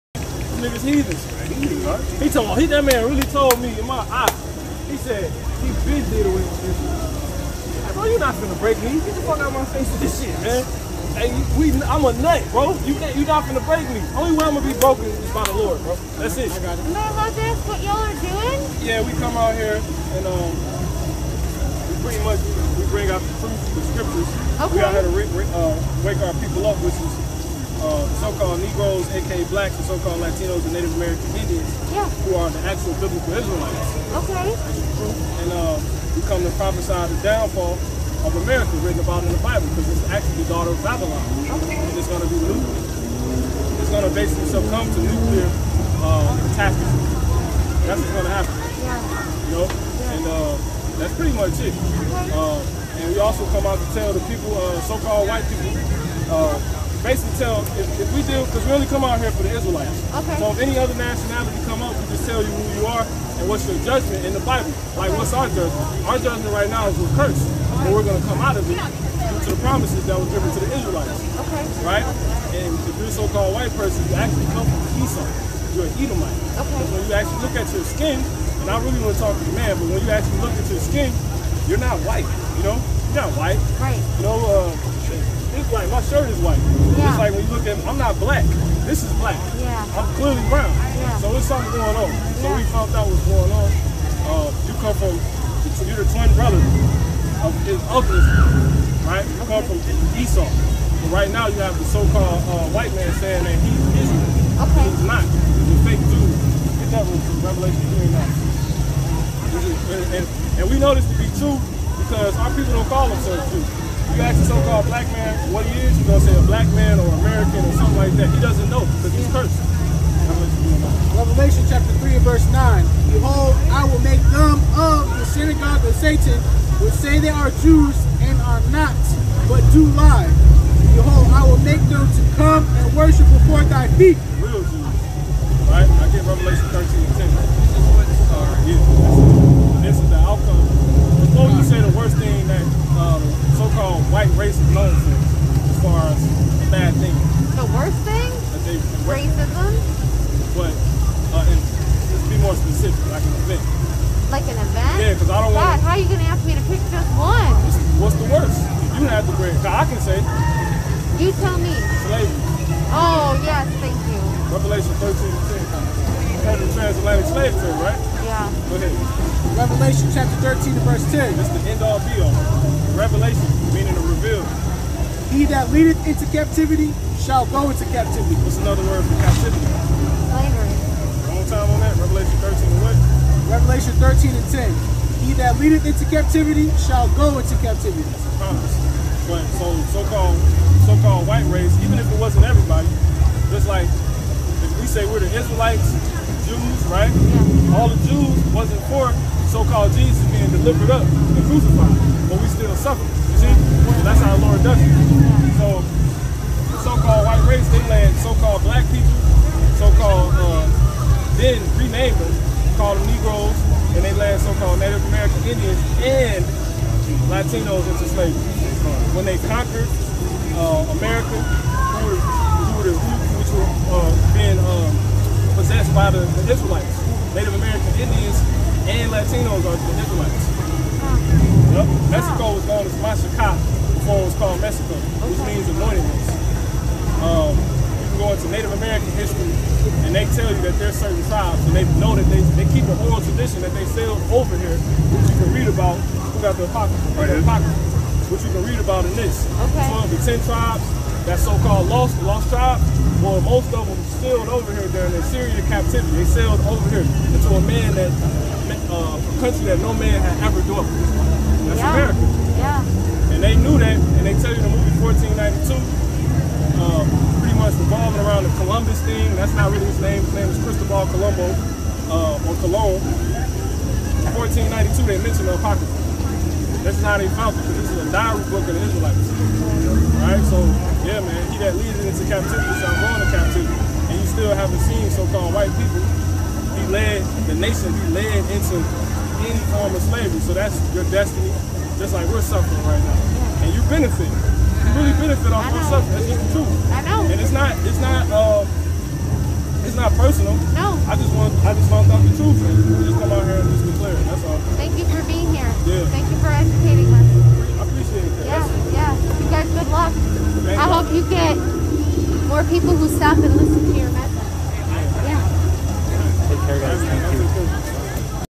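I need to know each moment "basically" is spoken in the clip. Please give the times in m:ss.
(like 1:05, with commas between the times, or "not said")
0:44, 0:57.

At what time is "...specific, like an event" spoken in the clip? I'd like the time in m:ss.
2:32.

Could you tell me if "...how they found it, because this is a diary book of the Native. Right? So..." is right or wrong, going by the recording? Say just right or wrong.
wrong.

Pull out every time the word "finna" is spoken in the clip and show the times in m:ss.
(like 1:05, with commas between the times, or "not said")
0:08, 0:13.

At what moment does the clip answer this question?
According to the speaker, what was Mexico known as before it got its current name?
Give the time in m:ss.
3:53.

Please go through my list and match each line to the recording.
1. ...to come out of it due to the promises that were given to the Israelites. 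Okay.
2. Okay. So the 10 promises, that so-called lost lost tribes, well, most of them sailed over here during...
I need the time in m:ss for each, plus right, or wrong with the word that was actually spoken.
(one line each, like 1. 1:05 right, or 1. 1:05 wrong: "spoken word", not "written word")
1. 1:08 right
2. 4:09 wrong: "tribes", not "promises".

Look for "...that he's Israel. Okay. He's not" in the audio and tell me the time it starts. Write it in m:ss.
1:43.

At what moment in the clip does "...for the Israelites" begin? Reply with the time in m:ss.
0:59.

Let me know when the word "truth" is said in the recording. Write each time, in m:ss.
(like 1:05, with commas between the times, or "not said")
0:23, 5:02.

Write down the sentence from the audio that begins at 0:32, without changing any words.
who are the actual biblical Israelites.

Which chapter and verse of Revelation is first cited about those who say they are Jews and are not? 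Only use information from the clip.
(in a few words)
Revelation 3:9.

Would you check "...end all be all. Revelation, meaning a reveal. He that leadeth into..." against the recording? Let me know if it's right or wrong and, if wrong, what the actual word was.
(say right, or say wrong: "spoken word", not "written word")
right.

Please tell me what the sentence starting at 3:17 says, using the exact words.
All the Jews wasn't for so-called Jesus being delivered up and crucified, but we still suffer.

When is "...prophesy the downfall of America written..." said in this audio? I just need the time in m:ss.
0:36.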